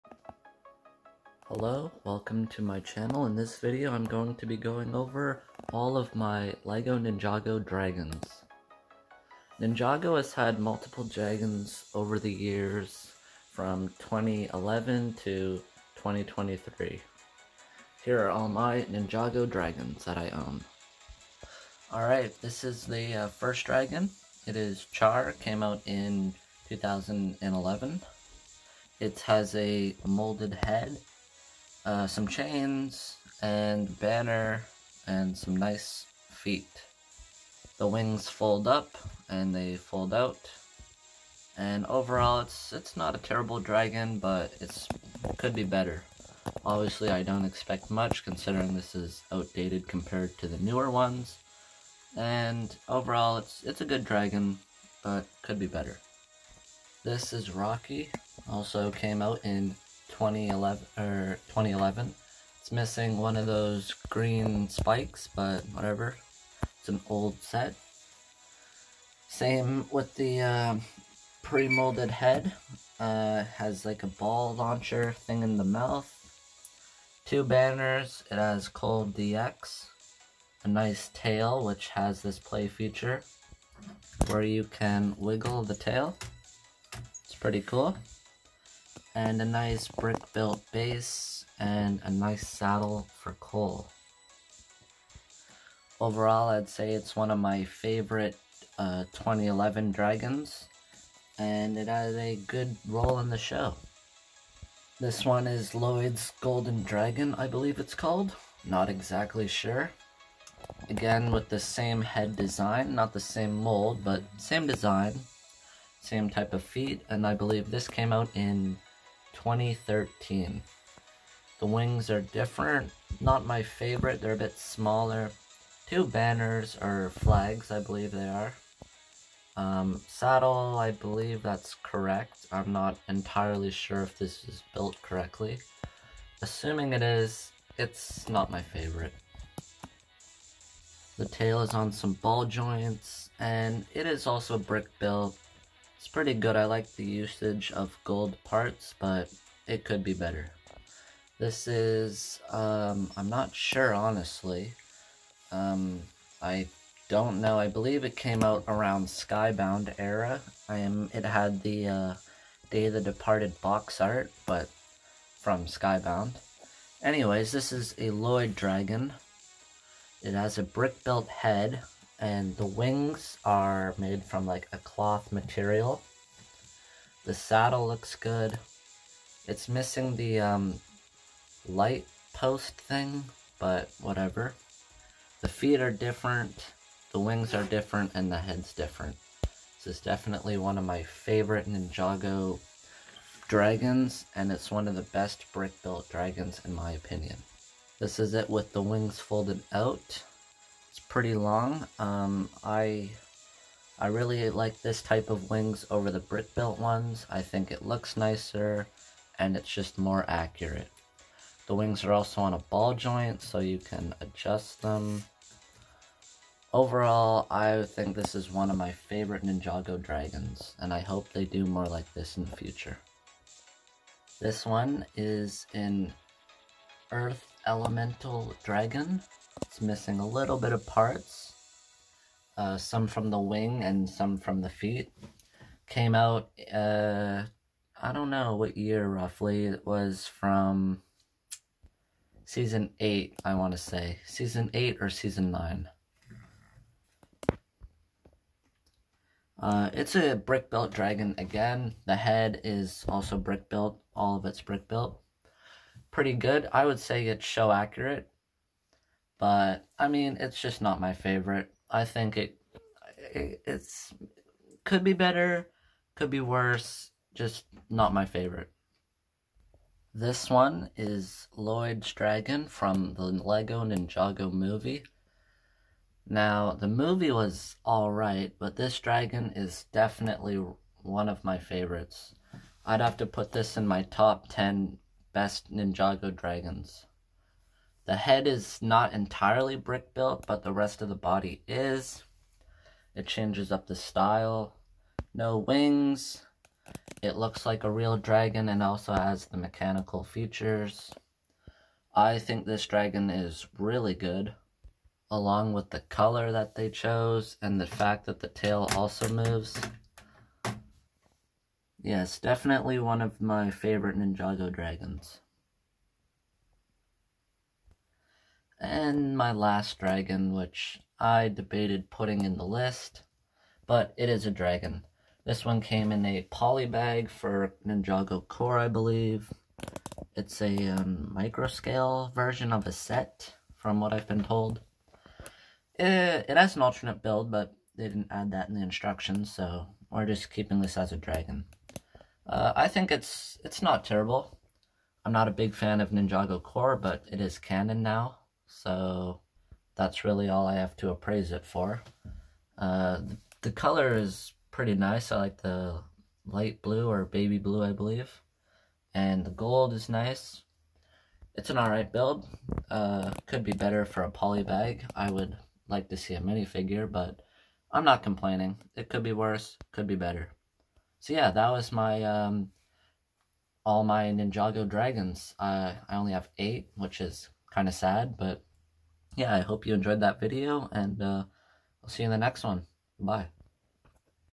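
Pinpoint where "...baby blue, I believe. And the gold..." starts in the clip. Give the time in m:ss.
5:57.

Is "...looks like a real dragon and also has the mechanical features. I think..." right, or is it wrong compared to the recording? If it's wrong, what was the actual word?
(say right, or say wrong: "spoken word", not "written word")
right.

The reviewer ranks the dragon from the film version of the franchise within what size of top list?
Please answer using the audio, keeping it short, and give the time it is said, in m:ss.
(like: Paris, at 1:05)
top 10, at 4:44.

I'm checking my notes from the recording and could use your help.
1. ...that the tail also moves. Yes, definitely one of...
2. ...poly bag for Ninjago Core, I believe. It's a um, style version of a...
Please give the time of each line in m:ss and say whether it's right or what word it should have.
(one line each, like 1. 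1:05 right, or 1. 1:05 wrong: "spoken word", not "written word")
1. 5:08 right
2. 5:26 wrong: "microscale", not "style".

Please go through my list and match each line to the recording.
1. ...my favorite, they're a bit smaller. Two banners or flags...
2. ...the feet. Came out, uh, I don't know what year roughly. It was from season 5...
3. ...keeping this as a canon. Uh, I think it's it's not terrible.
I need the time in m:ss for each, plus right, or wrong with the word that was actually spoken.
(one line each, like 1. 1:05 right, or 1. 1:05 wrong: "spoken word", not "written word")
1. 2:03 right
2. 3:54 wrong: "8", not "5"
3. 5:40 wrong: "dragon", not "canon".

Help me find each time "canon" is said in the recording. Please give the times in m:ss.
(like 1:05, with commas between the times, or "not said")
5:47.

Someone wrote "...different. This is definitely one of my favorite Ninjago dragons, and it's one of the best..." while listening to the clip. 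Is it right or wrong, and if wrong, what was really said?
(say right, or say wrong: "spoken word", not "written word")
right.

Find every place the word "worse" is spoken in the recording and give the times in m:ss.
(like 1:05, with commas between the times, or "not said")
4:26, 6:09.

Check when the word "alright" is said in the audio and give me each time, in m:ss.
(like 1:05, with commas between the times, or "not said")
0:21, 4:37, 6:01.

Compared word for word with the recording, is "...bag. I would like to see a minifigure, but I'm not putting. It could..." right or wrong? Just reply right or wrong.
wrong.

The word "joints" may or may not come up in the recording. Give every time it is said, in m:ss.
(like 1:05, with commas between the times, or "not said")
2:22, 3:32.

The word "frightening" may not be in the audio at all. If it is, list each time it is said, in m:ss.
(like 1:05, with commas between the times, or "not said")
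not said.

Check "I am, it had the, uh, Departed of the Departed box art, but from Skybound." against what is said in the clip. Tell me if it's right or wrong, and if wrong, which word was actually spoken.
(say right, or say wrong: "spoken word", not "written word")
wrong: "Day", not "Departed".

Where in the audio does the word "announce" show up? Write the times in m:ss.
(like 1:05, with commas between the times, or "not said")
not said.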